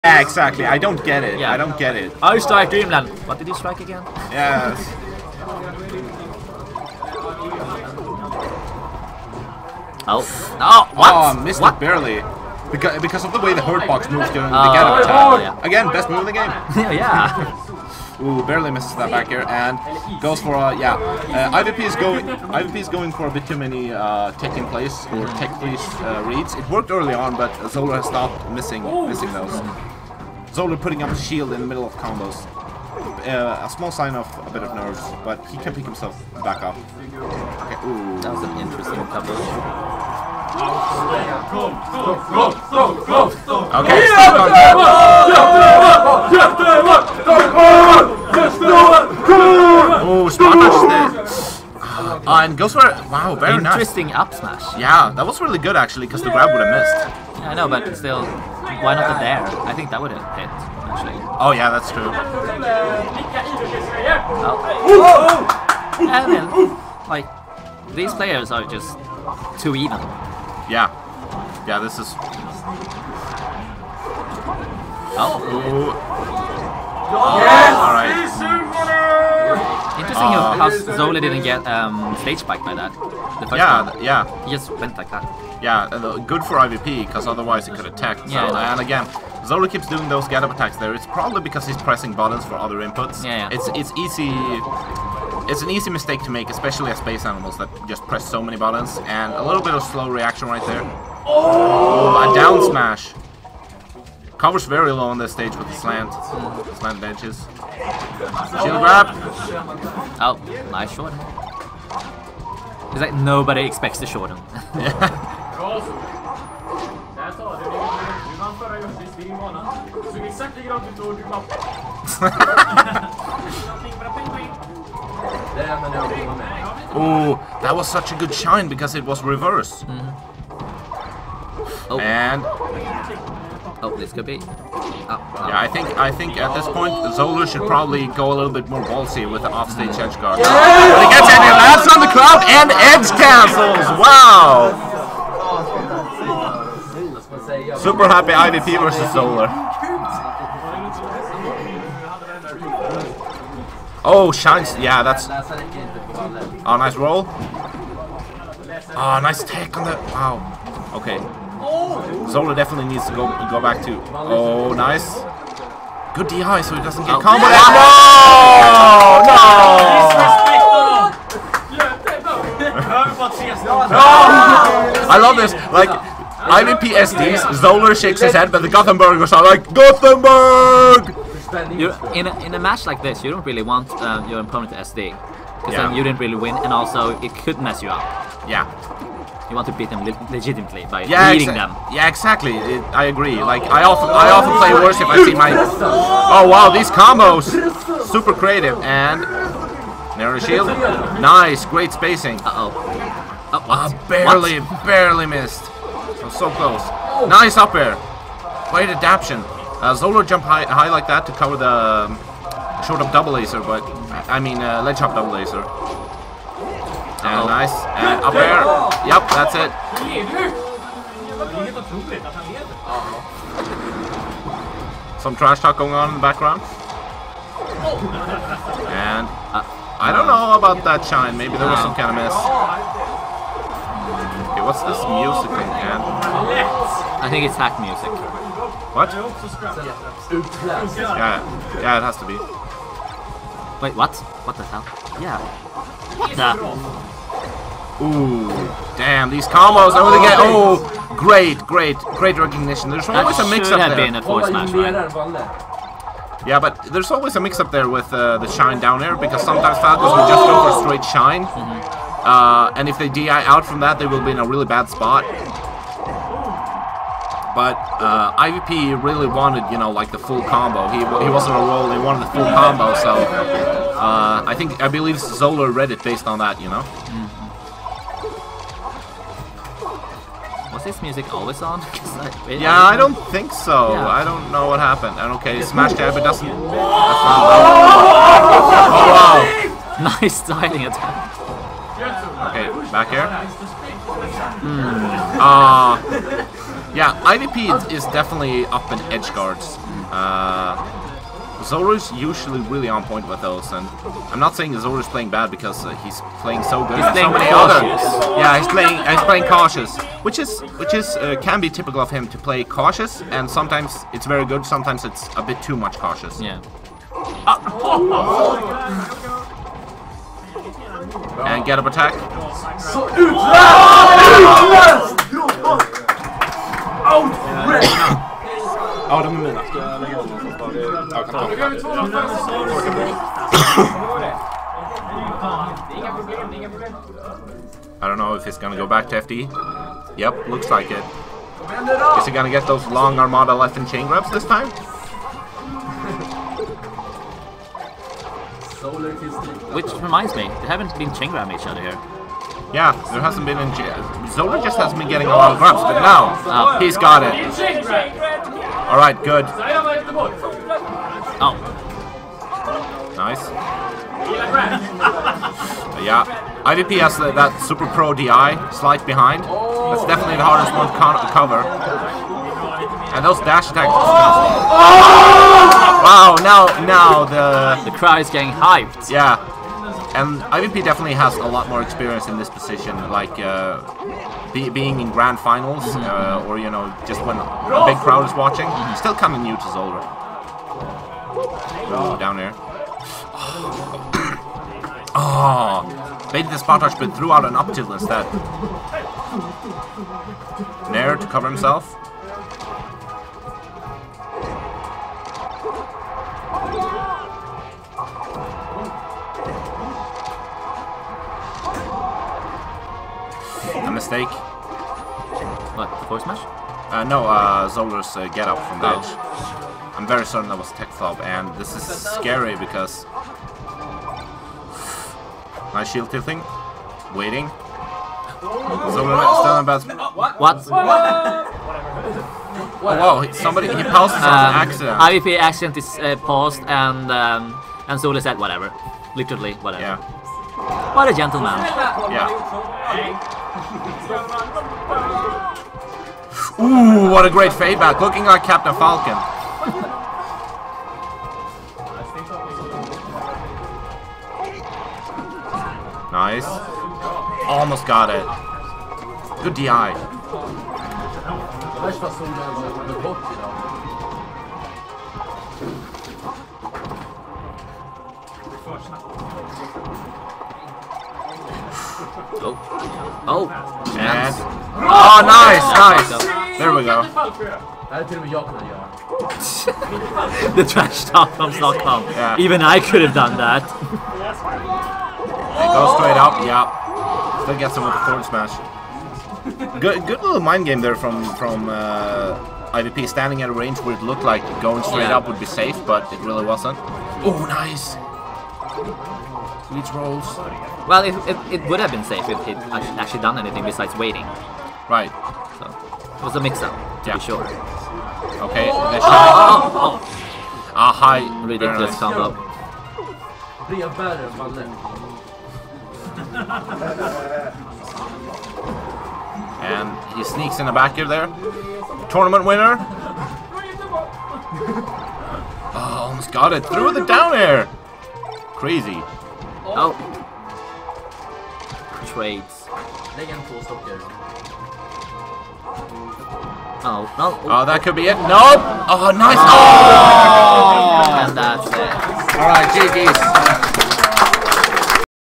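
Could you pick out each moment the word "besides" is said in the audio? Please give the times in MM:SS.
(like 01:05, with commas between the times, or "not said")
08:23.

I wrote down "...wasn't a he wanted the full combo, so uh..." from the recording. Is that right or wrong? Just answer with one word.
right.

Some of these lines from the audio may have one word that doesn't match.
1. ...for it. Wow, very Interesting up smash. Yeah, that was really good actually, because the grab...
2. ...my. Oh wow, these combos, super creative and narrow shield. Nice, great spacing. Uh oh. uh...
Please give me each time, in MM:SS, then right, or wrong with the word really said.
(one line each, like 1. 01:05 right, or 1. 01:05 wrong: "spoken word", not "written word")
1. 00:52 right
2. 03:15 right.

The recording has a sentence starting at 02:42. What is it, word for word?
Zoler definitely needs to go go back to.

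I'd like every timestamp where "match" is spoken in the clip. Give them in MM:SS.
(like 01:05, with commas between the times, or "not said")
03:02, 04:14.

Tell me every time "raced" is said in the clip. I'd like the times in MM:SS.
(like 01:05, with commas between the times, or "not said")
not said.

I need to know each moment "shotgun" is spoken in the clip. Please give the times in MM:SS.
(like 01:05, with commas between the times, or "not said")
not said.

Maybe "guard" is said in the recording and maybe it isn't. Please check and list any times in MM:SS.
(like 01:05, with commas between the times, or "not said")
02:20, 04:59.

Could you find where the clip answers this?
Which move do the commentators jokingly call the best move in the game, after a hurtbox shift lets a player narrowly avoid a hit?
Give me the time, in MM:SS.
00:14.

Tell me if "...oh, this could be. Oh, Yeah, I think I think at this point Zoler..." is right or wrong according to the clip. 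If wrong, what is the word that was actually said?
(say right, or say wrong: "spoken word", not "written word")
right.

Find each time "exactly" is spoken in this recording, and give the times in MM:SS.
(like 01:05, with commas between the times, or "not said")
00:00, 03:12.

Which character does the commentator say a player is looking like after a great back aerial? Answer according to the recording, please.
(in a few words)
Captain Falcon.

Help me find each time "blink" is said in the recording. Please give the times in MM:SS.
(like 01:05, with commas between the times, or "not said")
not said.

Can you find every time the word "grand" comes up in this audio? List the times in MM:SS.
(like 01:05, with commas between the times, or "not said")
06:25.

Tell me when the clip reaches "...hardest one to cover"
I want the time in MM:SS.
06:10.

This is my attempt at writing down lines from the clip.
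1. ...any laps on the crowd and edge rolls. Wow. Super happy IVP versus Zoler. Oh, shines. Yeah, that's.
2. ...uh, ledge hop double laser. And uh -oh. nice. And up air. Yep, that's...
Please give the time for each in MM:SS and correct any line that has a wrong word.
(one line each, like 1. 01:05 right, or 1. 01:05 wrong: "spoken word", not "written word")
1. 02:21 wrong: "cancels", not "rolls"
2. 03:34 right.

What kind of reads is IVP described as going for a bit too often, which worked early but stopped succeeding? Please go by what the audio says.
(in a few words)
tech in place.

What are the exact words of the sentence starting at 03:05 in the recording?
then you didn't really win, and also it could mess you up.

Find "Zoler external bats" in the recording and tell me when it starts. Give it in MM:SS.
07:08.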